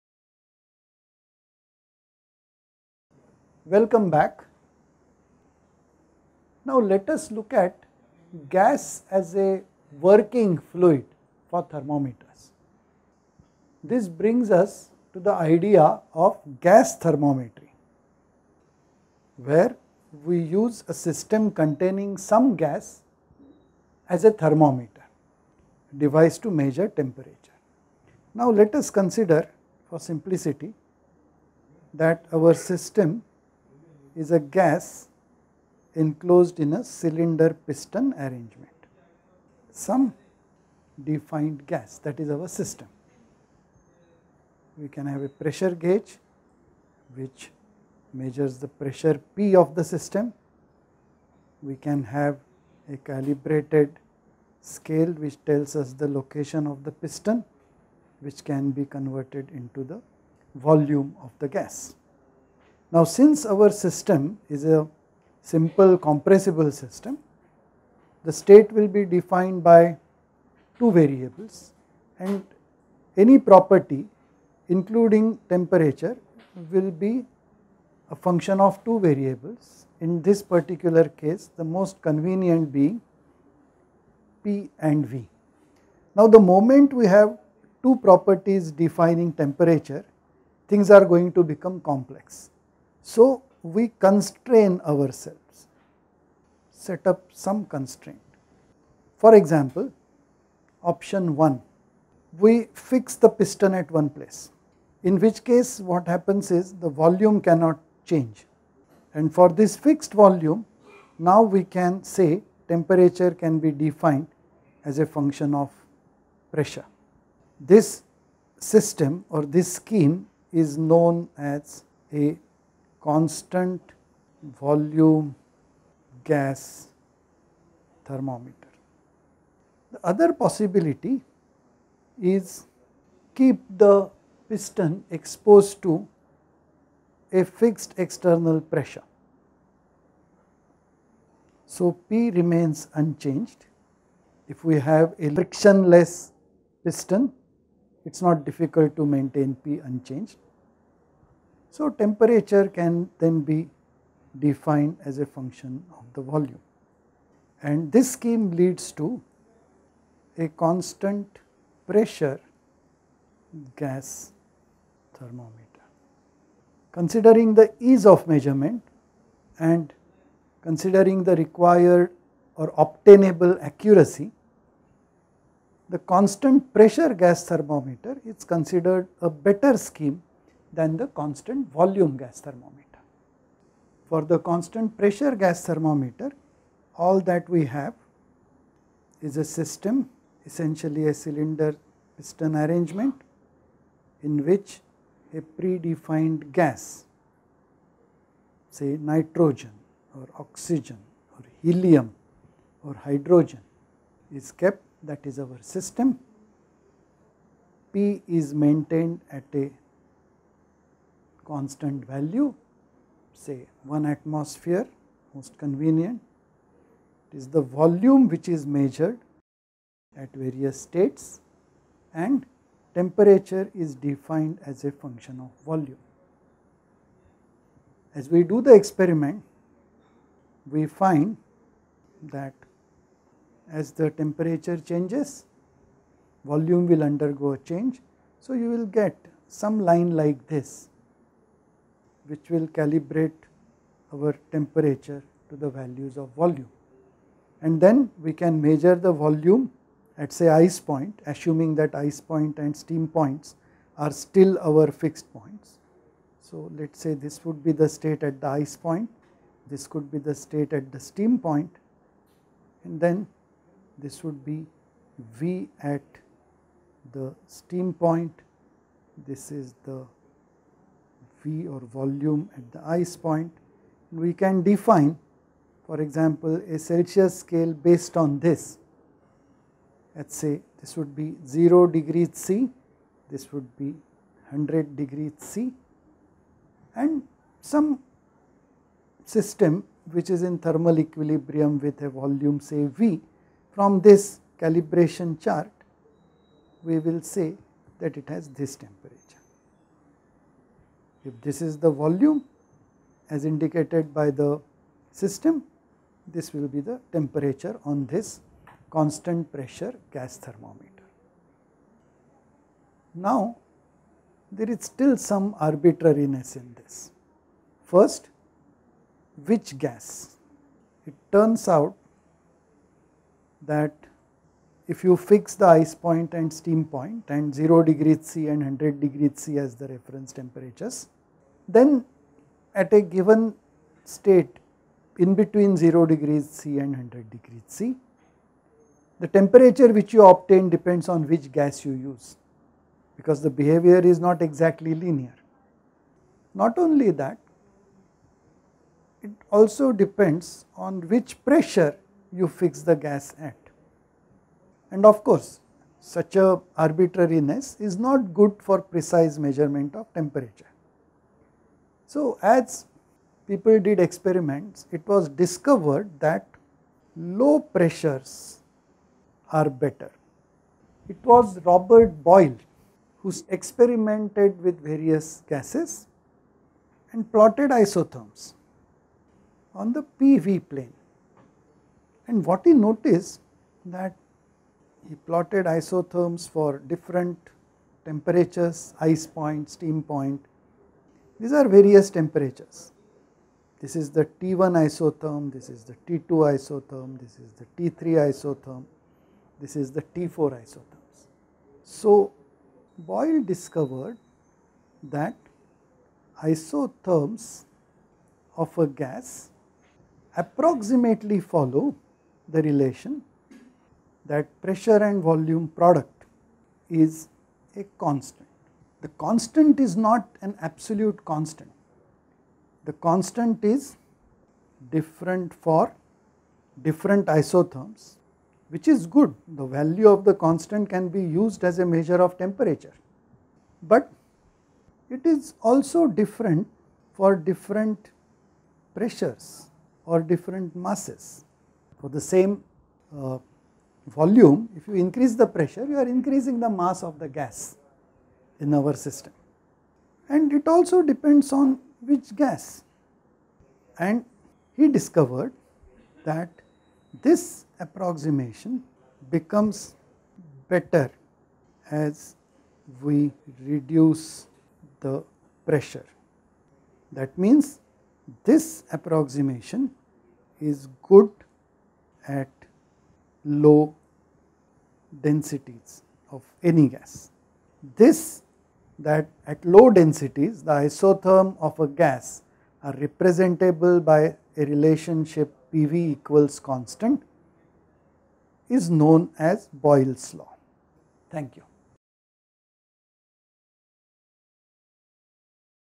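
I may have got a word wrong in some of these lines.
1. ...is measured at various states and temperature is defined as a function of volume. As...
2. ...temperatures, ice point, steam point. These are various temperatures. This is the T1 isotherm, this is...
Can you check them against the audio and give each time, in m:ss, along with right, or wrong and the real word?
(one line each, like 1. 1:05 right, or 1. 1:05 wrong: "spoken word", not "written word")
1. 3:38 right
2. 6:28 right.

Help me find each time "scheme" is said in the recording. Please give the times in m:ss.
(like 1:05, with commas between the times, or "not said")
1:59, 2:38, 2:59.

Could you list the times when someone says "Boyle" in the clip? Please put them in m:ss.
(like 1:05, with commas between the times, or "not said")
6:12, 6:42, 8:09.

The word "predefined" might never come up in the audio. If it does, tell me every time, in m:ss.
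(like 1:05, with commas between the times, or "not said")
3:15.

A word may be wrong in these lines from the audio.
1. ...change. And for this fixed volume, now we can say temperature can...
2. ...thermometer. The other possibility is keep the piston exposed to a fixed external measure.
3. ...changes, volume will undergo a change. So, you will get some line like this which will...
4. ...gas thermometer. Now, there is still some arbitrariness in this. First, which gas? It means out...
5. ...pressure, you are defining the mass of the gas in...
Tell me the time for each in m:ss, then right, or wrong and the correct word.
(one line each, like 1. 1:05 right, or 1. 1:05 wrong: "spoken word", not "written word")
1. 1:48 right
2. 2:08 wrong: "pressure", not "measure"
3. 3:54 right
4. 5:10 wrong: "turns", not "means"
5. 7:25 wrong: "increasing", not "defining".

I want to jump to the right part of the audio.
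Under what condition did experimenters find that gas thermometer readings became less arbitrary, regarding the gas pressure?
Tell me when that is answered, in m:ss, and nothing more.
6:07.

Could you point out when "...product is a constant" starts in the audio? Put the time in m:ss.
6:55.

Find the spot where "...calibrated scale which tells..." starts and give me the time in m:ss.
0:52.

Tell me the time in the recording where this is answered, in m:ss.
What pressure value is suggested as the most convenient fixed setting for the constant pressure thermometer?
3:33.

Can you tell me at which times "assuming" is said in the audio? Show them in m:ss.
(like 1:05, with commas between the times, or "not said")
4:11.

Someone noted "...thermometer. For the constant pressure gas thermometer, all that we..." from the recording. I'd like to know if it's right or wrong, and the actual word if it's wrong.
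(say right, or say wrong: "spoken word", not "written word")
right.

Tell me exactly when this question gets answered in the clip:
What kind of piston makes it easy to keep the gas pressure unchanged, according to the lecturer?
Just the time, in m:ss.
2:25.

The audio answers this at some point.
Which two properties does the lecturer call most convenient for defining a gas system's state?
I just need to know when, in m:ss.
1:24.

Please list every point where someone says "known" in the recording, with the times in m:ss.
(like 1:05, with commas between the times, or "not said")
2:00, 8:08.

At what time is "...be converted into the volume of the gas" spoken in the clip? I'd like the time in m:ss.
0:58.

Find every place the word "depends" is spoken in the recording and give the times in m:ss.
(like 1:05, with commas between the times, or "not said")
5:40, 5:49, 7:31.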